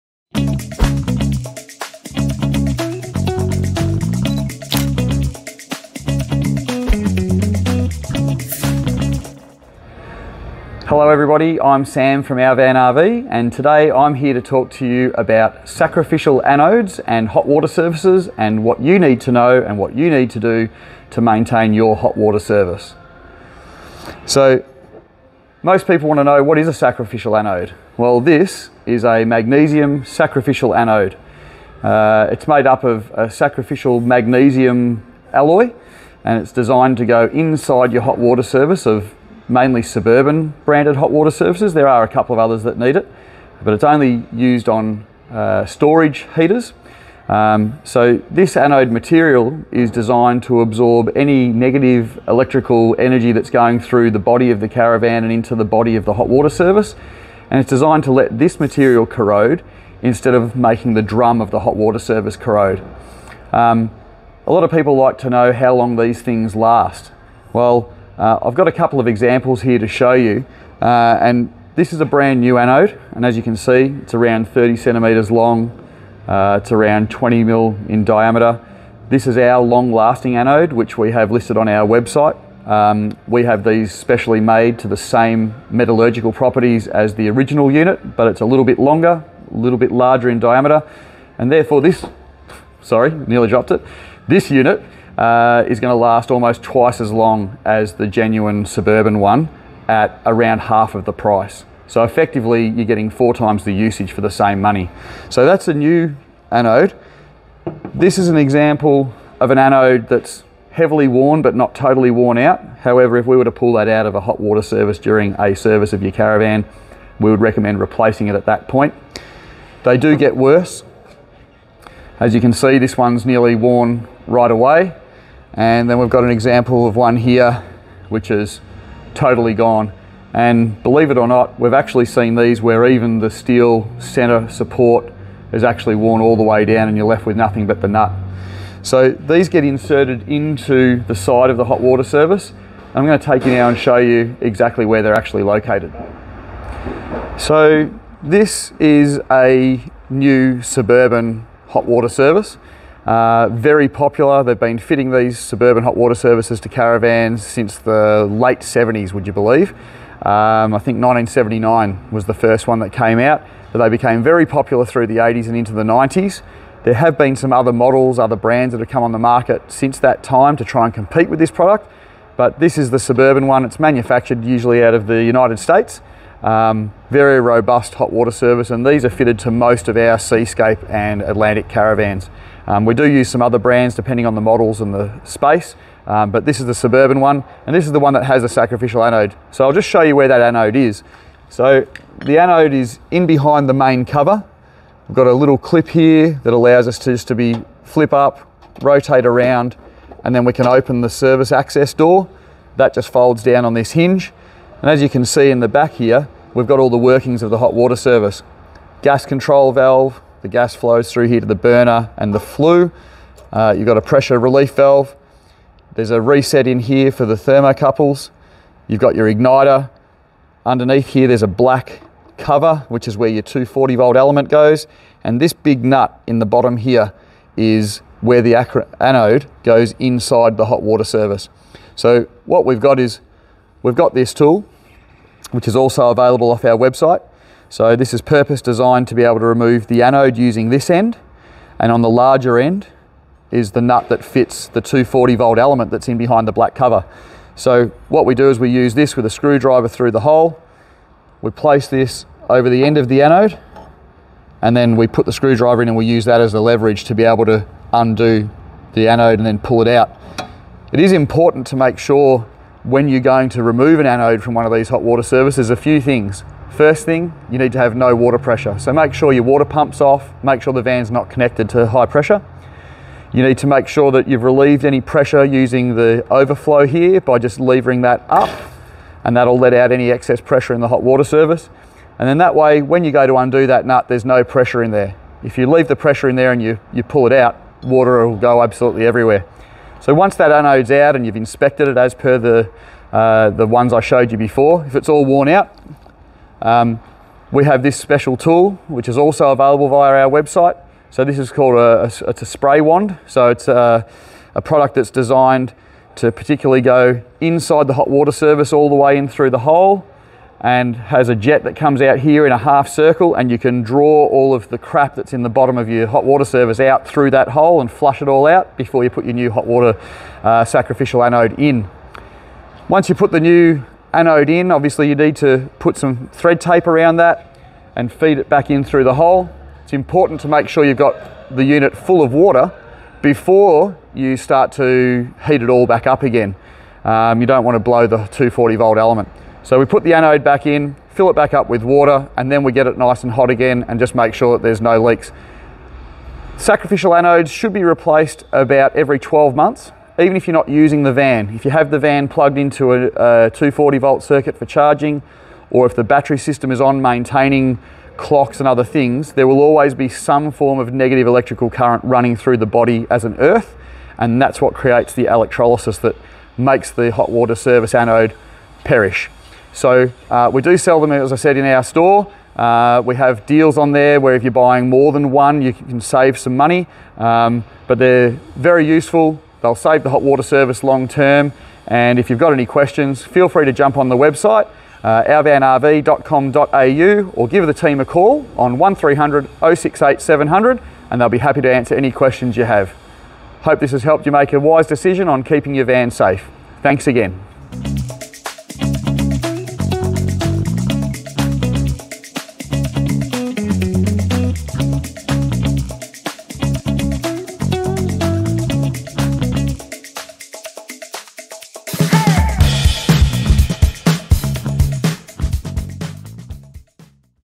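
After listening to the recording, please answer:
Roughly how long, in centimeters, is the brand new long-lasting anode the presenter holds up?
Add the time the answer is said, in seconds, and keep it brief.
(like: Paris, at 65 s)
30 centimeters, at 74 s.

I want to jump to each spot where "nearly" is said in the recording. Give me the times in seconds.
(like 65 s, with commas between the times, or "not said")
93 s, 123 s.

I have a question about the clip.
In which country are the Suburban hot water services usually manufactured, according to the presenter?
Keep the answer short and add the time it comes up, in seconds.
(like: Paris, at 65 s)
United States, at 175 s.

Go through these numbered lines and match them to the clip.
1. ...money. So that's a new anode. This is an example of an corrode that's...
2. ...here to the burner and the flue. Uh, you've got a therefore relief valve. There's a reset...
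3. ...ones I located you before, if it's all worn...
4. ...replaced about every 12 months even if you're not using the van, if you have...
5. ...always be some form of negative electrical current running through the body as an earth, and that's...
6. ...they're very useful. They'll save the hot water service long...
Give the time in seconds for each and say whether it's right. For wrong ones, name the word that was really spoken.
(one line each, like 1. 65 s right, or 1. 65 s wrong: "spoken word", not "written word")
1. 104 s wrong: "anode", not "corrode"
2. 211 s wrong: "pressure", not "therefore"
3. 293 s wrong: "showed", not "located"
4. 347 s right
5. 359 s right
6. 377 s right.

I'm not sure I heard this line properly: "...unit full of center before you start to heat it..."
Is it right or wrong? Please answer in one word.
wrong.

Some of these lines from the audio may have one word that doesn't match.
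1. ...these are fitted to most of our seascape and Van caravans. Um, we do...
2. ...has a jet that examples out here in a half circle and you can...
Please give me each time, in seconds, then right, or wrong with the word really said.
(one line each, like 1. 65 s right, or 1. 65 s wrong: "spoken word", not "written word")
1. 178 s wrong: "Atlantic", not "Van"
2. 310 s wrong: "comes", not "examples".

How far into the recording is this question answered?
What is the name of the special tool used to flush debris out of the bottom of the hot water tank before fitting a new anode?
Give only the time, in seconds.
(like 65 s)
302 s.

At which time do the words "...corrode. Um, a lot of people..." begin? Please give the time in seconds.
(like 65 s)
62 s.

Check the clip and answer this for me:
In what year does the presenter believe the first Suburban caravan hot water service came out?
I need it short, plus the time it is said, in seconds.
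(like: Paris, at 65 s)
1979, at 161 s.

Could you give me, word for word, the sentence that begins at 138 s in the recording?
So these get inserted into the side of the hot water service.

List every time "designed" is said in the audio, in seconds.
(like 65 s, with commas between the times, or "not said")
36 s, 49 s, 57 s, 238 s, 305 s.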